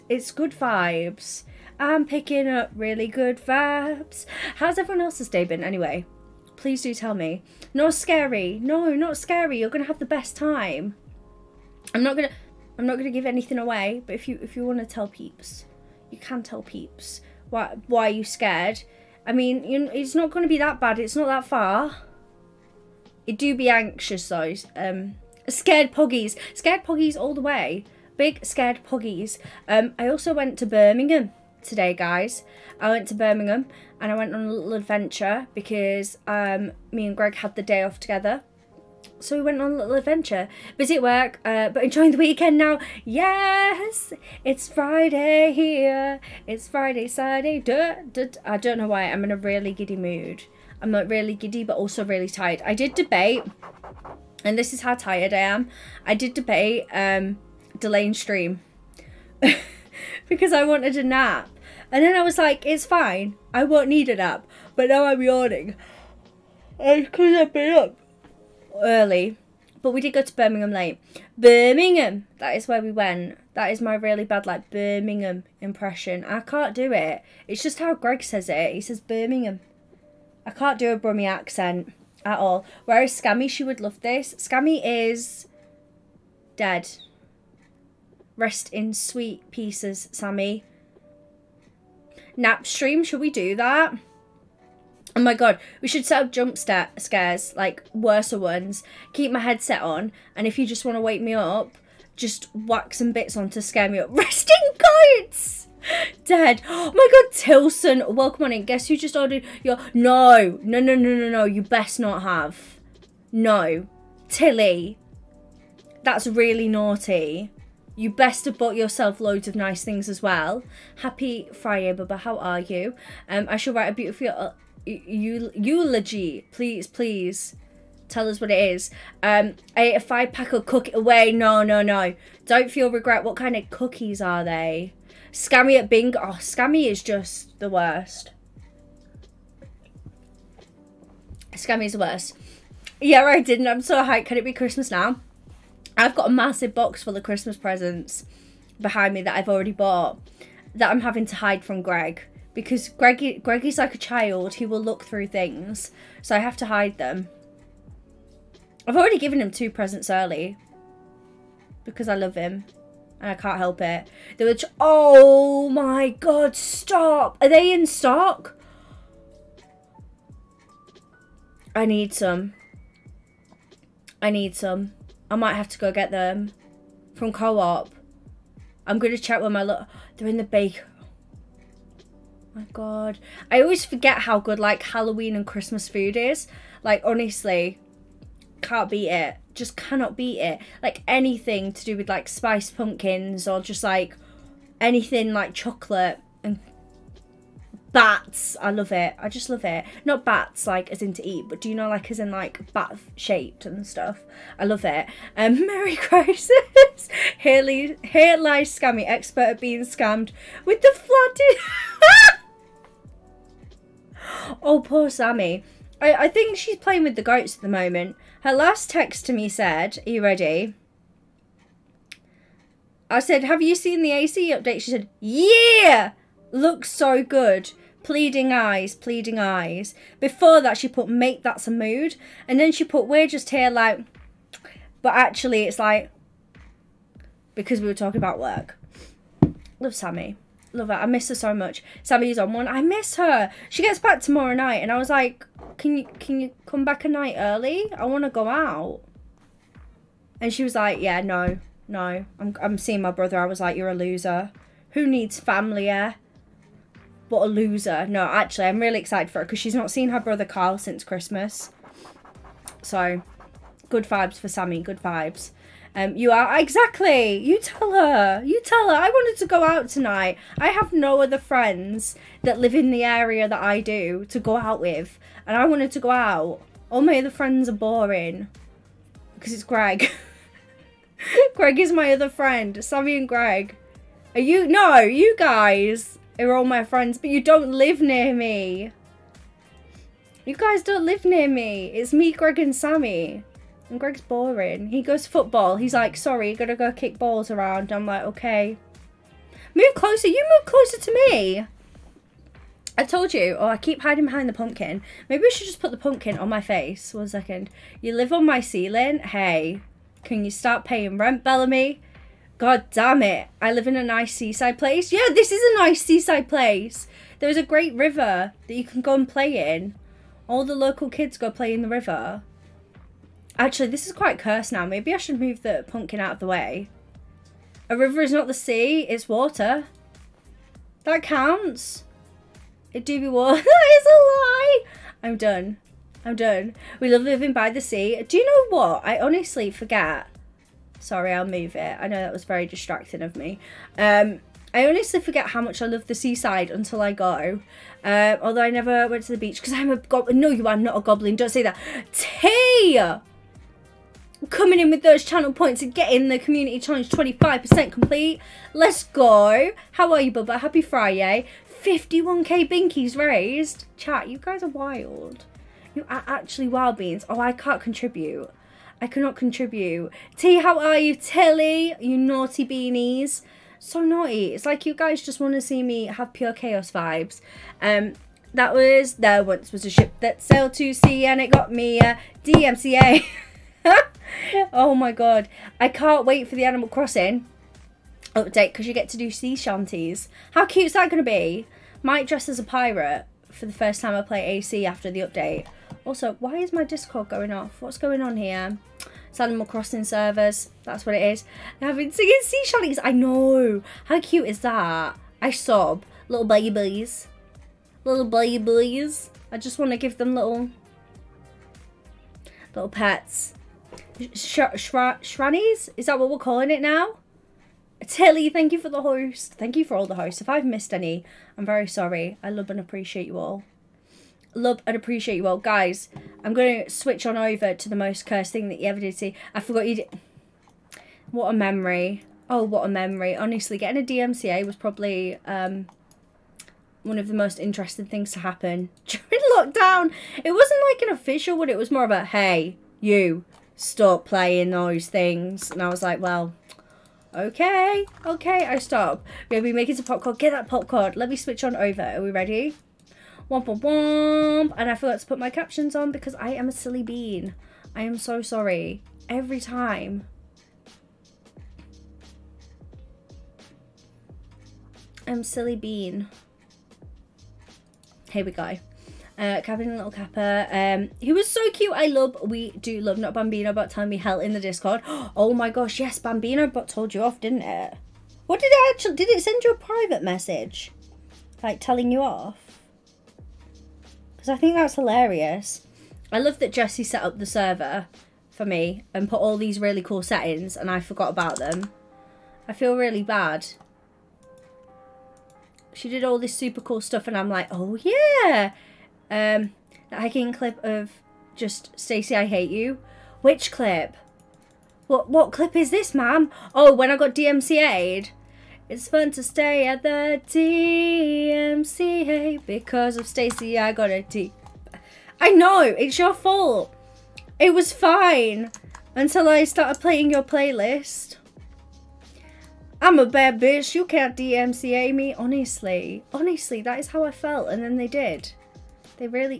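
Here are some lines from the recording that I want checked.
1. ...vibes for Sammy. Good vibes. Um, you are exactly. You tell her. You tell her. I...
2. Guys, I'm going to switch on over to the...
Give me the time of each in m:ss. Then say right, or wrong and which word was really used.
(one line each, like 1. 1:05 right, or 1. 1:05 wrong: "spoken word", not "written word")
1. 4:24 right
2. 7:05 right.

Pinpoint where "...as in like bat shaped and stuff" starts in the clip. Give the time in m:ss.
3:22.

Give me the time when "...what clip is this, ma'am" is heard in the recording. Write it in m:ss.
8:25.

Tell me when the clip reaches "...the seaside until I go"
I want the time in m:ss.
5:46.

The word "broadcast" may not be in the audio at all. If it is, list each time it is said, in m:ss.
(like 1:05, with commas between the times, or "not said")
not said.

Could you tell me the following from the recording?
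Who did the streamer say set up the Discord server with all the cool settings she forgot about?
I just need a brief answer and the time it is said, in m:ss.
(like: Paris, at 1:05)
Jesse, at 8:06.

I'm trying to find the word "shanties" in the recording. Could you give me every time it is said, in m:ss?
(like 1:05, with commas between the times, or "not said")
6:29, 6:42.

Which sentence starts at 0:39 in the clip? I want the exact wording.
So we went on a little adventure.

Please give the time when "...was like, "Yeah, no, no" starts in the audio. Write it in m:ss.
4:10.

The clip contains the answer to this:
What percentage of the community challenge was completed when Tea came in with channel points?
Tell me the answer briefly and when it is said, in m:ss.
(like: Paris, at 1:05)
25%, at 5:57.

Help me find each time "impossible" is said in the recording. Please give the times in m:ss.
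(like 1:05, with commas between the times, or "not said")
not said.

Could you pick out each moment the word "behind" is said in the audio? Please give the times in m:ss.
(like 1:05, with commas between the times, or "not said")
2:28, 5:04.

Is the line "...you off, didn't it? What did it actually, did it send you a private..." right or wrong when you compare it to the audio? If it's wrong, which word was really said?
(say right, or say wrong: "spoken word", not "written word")
right.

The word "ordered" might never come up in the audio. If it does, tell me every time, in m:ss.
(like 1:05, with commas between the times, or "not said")
1:49.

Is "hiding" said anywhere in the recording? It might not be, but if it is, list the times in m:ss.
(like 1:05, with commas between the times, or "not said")
5:04.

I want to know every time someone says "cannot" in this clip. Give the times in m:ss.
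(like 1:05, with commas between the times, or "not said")
3:09, 6:09.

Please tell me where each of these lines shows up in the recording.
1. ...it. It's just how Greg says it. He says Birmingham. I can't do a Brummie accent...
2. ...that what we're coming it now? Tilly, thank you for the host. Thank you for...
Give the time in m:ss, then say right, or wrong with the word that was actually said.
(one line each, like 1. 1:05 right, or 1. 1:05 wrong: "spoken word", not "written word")
1. 1:16 right
2. 6:56 wrong: "calling", not "coming".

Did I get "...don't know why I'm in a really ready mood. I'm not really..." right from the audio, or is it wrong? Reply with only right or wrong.
wrong.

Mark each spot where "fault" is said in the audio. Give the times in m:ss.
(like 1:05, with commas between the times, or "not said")
8:36.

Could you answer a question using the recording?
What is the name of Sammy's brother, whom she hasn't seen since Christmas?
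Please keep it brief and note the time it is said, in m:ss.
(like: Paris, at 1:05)
Kyle, at 4:20.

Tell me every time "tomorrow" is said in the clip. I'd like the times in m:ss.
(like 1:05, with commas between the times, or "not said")
4:04.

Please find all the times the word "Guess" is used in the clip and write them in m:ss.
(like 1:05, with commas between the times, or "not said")
1:48.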